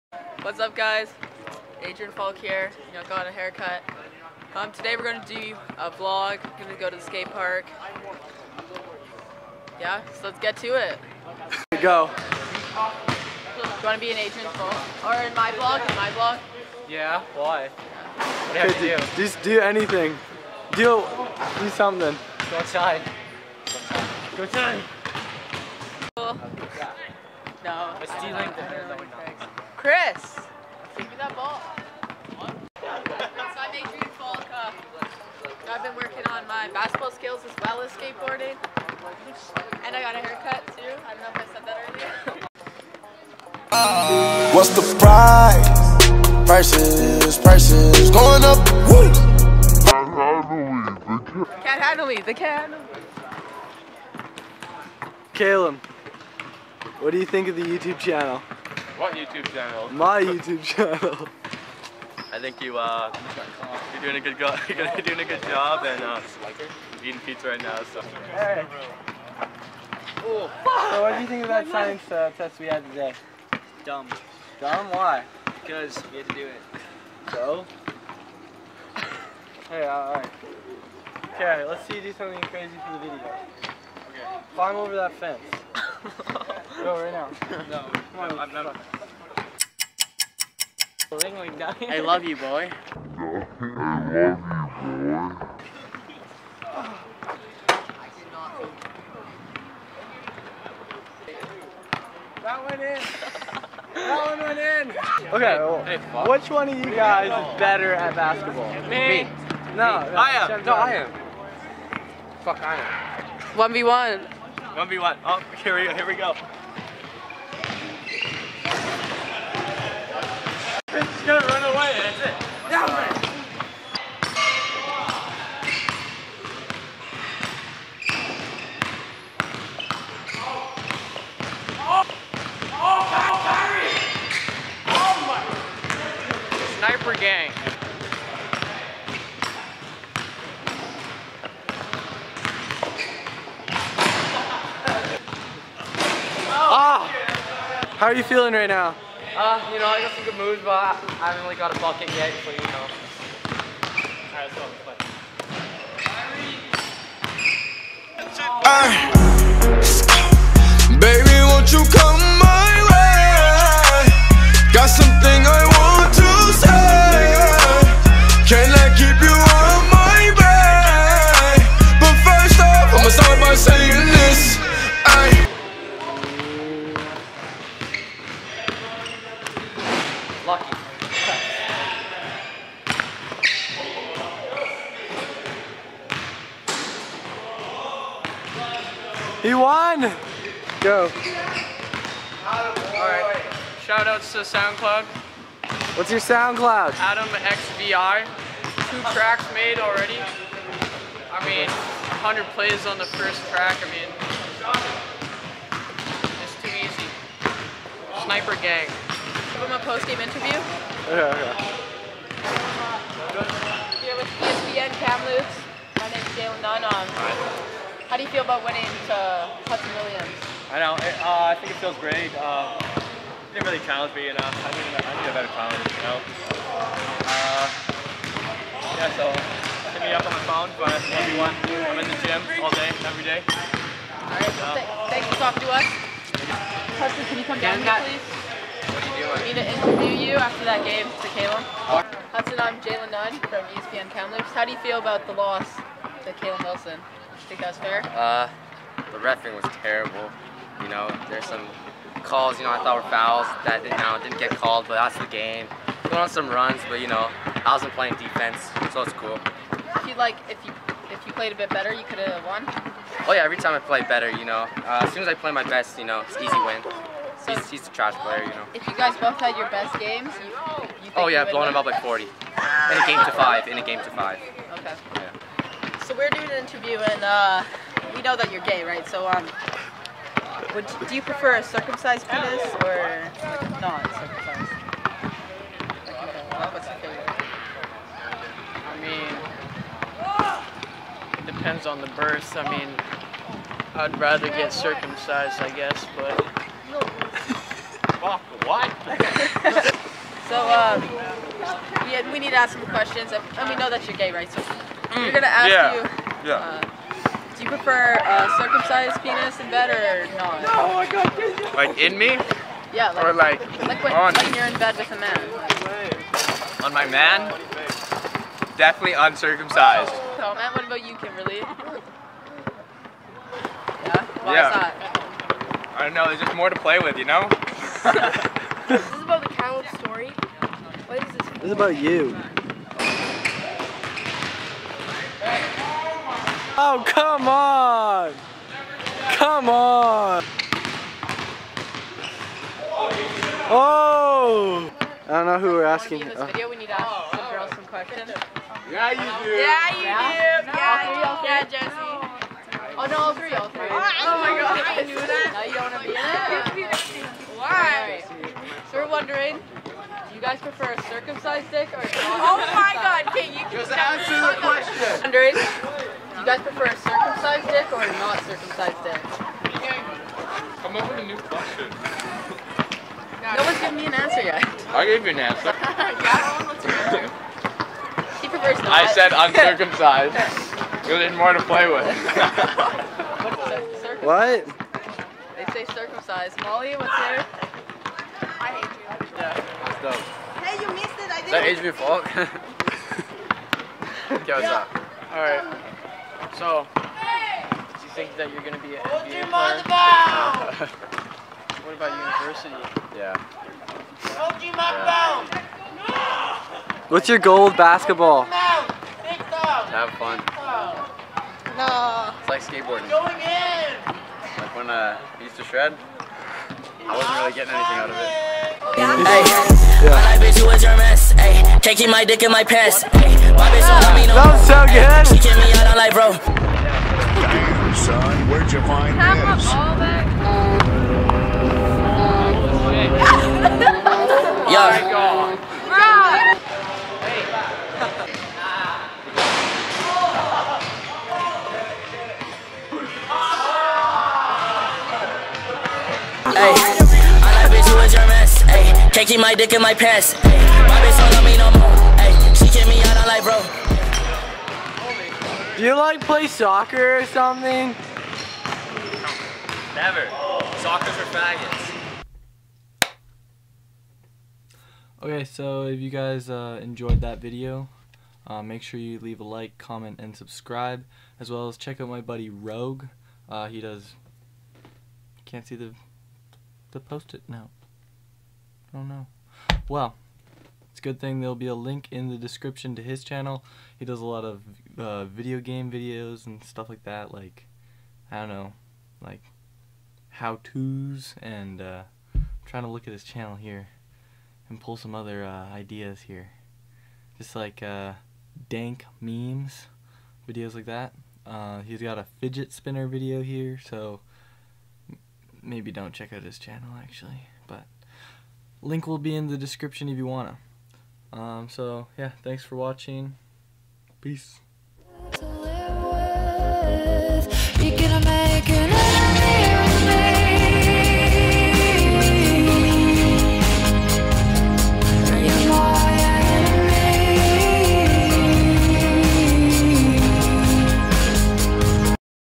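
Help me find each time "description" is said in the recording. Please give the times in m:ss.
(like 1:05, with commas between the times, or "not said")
8:02, 8:29.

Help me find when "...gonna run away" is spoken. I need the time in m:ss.
2:01.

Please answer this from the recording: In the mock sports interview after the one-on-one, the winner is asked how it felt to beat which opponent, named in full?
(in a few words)
Hudson Williams.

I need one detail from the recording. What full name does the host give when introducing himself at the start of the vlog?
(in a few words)
Adrian Falk.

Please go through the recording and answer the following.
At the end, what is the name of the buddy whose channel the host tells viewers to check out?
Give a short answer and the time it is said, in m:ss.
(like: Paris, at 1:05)
Rogue, at 7:52.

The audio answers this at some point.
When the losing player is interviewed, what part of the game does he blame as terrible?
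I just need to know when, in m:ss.
4:09.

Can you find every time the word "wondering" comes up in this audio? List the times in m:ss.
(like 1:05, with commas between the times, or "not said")
5:59, 6:05.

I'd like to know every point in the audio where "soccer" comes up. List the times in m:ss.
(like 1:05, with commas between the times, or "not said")
7:36, 7:40.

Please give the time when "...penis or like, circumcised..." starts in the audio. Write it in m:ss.
4:42.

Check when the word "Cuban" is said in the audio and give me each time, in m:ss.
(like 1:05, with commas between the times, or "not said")
not said.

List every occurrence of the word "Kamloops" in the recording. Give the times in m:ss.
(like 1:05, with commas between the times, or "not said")
3:35, 4:04.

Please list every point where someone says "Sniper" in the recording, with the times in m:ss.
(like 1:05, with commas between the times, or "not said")
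2:16, 3:28.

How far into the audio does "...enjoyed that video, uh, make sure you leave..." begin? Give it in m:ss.
7:46.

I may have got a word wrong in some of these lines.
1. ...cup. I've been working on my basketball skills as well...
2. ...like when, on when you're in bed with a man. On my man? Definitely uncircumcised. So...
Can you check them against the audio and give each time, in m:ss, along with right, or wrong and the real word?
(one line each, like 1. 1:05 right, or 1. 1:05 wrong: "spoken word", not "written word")
1. 0:34 right
2. 5:13 right.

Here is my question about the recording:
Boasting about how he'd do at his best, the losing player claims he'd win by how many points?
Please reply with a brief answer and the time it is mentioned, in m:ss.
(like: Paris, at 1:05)
40, at 4:31.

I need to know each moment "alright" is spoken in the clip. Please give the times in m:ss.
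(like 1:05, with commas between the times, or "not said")
1:19, 2:34, 3:12, 6:35.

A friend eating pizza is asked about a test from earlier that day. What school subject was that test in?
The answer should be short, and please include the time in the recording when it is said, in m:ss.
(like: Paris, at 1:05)
Science, at 1:11.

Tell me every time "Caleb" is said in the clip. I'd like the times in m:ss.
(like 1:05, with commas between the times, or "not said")
0:55, 4:01, 4:06.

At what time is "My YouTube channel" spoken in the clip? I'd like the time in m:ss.
0:59.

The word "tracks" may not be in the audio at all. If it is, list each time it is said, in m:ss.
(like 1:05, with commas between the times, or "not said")
3:19, 3:23.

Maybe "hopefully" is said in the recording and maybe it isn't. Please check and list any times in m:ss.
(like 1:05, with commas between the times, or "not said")
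not said.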